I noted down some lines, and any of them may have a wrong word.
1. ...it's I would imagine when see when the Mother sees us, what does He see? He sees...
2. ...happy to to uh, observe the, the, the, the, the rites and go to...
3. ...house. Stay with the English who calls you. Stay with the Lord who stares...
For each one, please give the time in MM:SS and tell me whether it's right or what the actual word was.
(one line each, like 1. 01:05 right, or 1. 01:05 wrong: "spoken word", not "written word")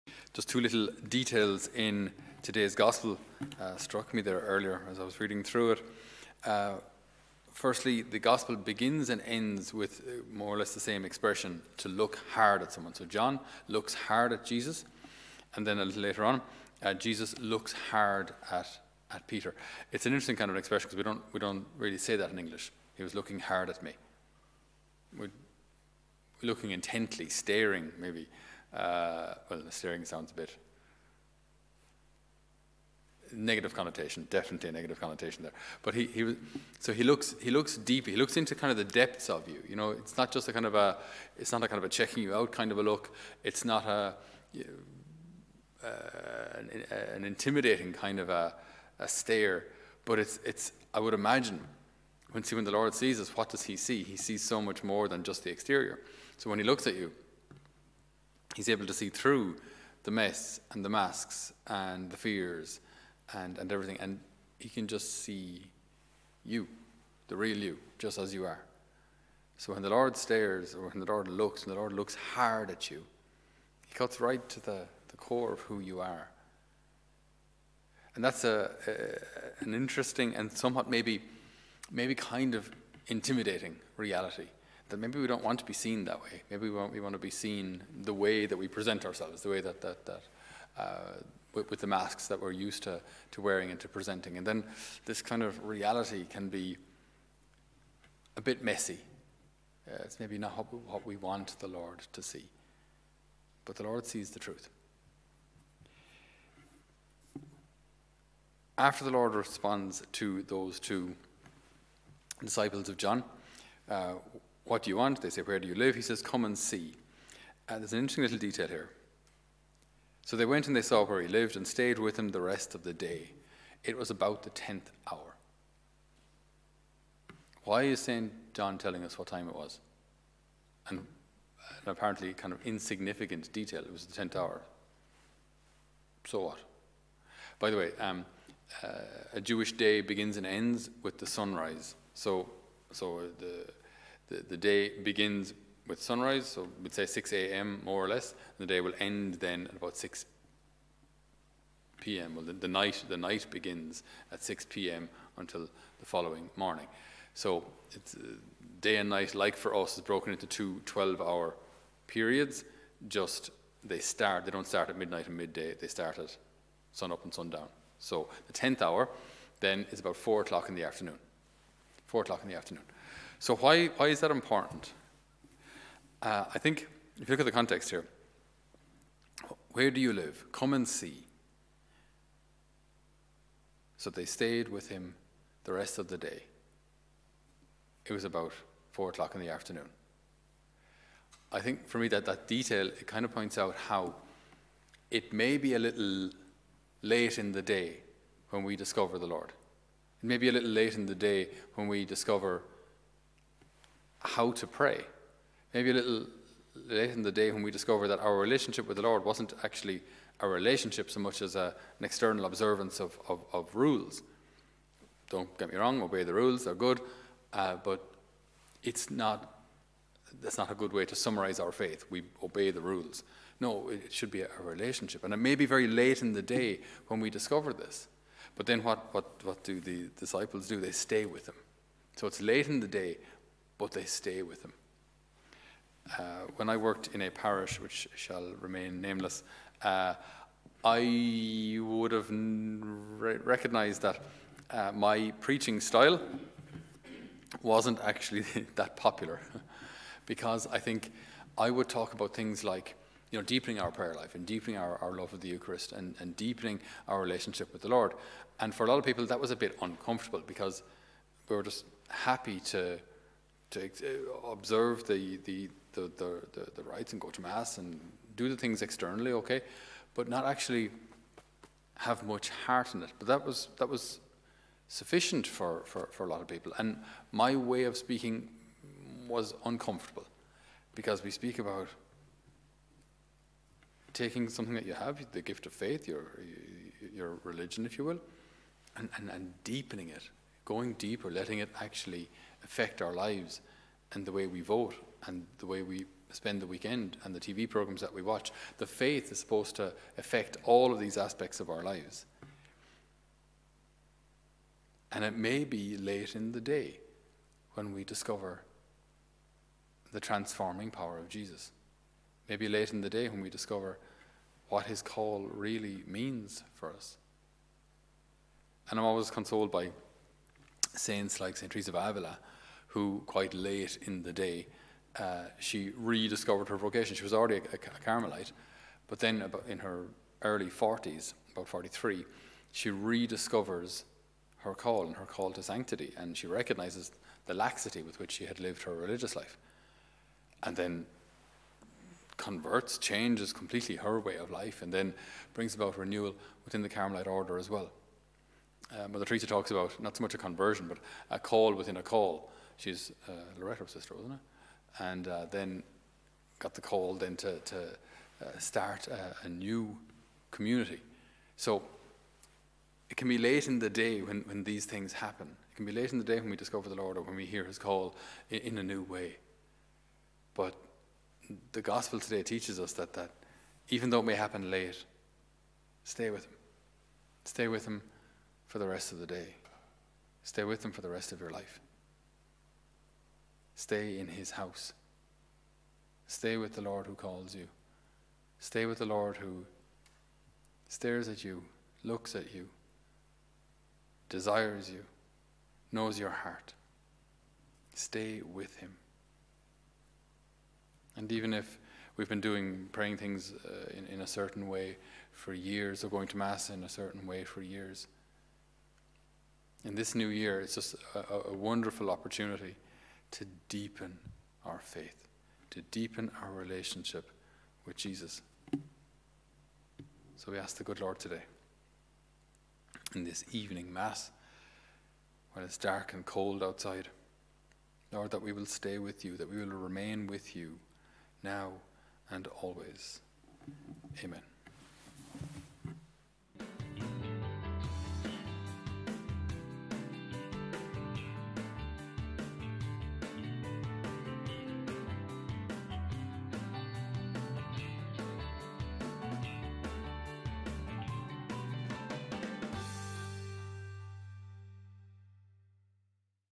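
1. 00:50 wrong: "Lord", not "Mother"
2. 04:22 right
3. 06:24 wrong: "Lord", not "English".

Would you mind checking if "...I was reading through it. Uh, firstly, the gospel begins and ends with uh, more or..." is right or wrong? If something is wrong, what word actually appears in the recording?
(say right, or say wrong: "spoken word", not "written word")
right.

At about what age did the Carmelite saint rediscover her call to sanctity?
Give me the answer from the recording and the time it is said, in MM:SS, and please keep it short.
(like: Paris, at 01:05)
43, at 05:31.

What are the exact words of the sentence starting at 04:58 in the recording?
The faith is supposed to affect all of these aspects of our lives.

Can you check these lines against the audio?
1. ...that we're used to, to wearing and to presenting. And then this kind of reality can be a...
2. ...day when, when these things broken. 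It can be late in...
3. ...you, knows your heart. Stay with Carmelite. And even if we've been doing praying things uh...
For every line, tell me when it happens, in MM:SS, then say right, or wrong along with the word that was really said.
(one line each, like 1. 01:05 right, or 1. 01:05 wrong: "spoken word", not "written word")
1. 01:32 right
2. 06:03 wrong: "happen", not "broken"
3. 06:34 wrong: "Him", not "Carmelite".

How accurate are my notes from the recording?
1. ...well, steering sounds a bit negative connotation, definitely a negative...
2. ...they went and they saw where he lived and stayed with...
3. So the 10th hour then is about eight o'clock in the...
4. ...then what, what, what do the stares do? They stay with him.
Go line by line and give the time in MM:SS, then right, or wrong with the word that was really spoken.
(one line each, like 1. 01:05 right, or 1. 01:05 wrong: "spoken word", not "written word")
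1. 00:29 right
2. 02:00 right
3. 02:47 wrong: "four", not "eight"
4. 03:48 wrong: "disciples", not "stares".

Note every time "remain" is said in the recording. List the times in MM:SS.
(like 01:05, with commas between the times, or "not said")
03:58, 07:09.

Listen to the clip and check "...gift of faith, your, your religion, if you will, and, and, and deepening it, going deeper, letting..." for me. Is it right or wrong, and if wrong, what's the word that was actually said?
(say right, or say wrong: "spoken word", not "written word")
right.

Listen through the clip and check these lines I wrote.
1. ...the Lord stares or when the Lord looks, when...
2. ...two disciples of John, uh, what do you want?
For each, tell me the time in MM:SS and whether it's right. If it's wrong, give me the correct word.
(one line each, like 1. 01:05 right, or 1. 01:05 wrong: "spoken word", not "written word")
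1. 01:09 right
2. 01:50 right.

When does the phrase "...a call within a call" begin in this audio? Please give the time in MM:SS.
05:51.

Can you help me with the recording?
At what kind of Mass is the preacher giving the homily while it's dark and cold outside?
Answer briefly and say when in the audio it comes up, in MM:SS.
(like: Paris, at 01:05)
evening Mass, at 07:03.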